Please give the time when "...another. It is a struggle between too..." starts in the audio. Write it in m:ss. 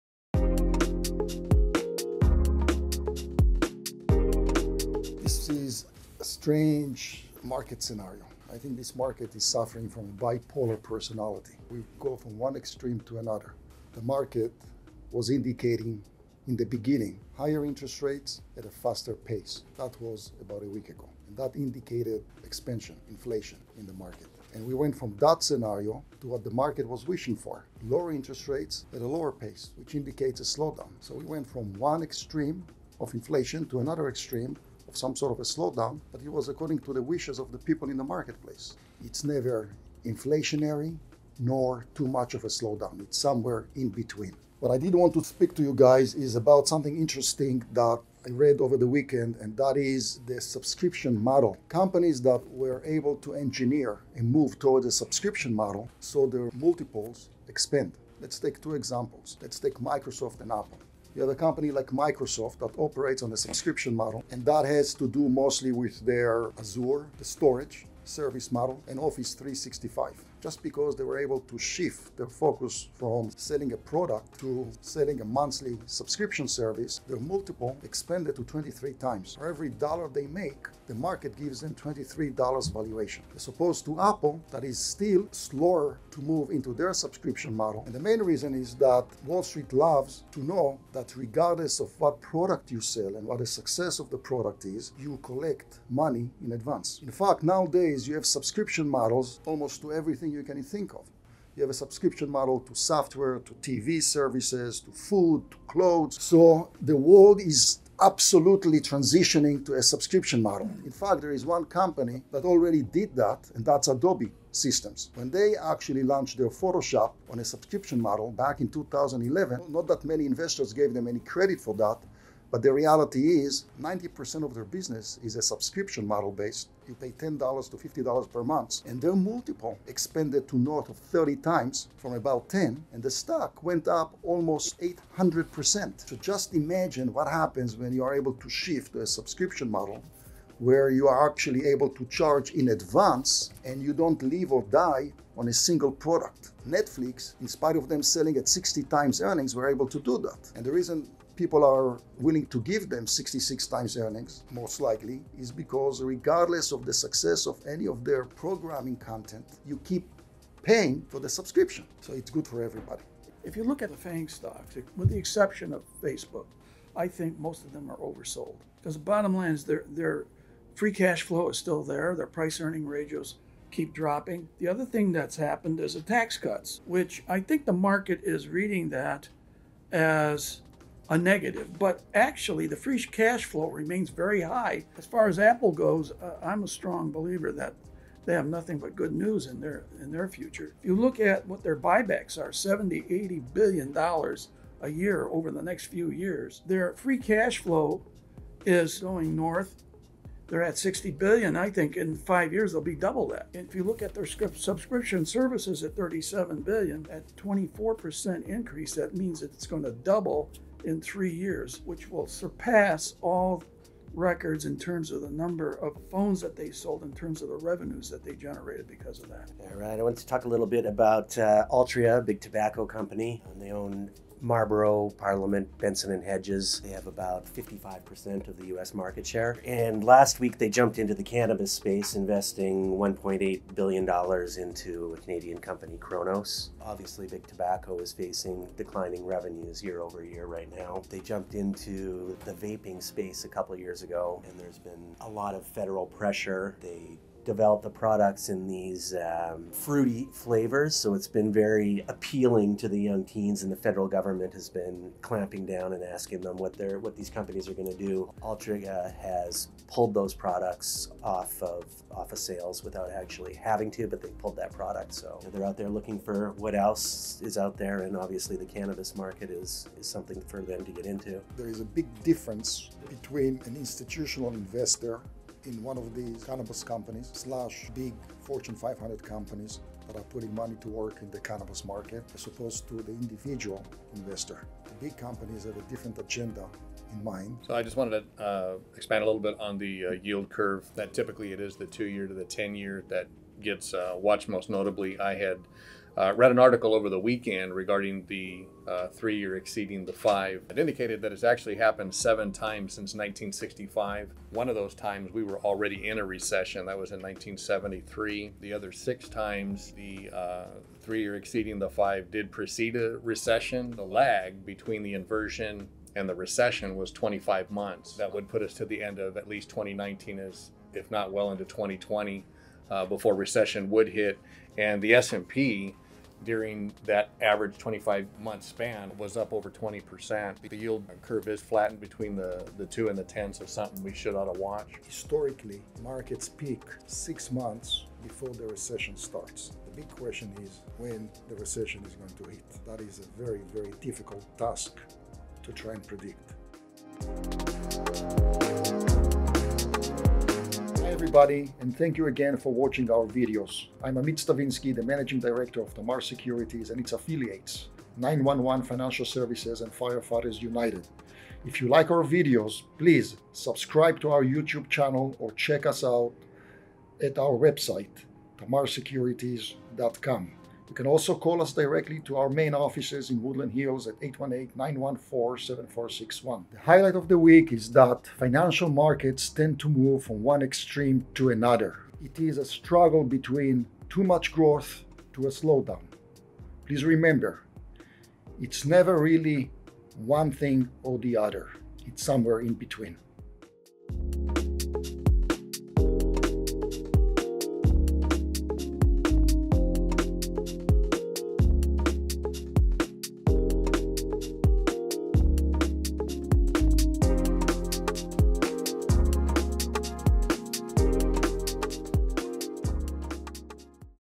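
6:21.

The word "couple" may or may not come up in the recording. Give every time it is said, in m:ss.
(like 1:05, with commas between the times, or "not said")
4:03.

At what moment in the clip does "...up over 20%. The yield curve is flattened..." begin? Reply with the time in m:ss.
5:29.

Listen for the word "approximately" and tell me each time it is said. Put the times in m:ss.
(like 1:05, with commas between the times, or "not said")
not said.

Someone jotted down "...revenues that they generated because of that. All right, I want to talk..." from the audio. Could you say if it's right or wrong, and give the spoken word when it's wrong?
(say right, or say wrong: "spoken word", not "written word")
right.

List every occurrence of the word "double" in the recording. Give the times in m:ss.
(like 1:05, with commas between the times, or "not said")
3:22, 3:29.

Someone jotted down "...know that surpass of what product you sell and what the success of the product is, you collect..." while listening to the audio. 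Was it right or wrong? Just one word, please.
wrong.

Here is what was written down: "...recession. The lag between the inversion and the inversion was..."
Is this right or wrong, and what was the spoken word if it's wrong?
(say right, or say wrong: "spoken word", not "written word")
wrong: "recession", not "inversion".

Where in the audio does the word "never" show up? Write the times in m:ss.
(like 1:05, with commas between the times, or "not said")
0:39, 6:28.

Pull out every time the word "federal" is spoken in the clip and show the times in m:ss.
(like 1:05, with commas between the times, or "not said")
4:05, 4:13.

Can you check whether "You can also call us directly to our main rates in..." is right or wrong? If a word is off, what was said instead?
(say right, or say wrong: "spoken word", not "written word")
wrong: "offices", not "rates".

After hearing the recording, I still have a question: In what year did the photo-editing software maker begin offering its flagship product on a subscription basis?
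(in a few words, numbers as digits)
2011.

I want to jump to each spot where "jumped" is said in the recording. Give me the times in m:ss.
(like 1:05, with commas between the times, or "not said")
3:50, 4:01.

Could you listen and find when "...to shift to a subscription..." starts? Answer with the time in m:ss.
2:18.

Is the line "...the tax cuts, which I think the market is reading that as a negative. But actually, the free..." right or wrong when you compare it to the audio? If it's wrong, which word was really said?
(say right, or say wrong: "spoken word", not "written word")
right.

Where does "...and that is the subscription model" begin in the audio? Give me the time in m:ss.
0:49.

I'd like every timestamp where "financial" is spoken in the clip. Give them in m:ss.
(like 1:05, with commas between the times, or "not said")
5:58, 6:18.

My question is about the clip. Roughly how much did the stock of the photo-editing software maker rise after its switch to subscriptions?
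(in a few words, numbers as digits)
800%.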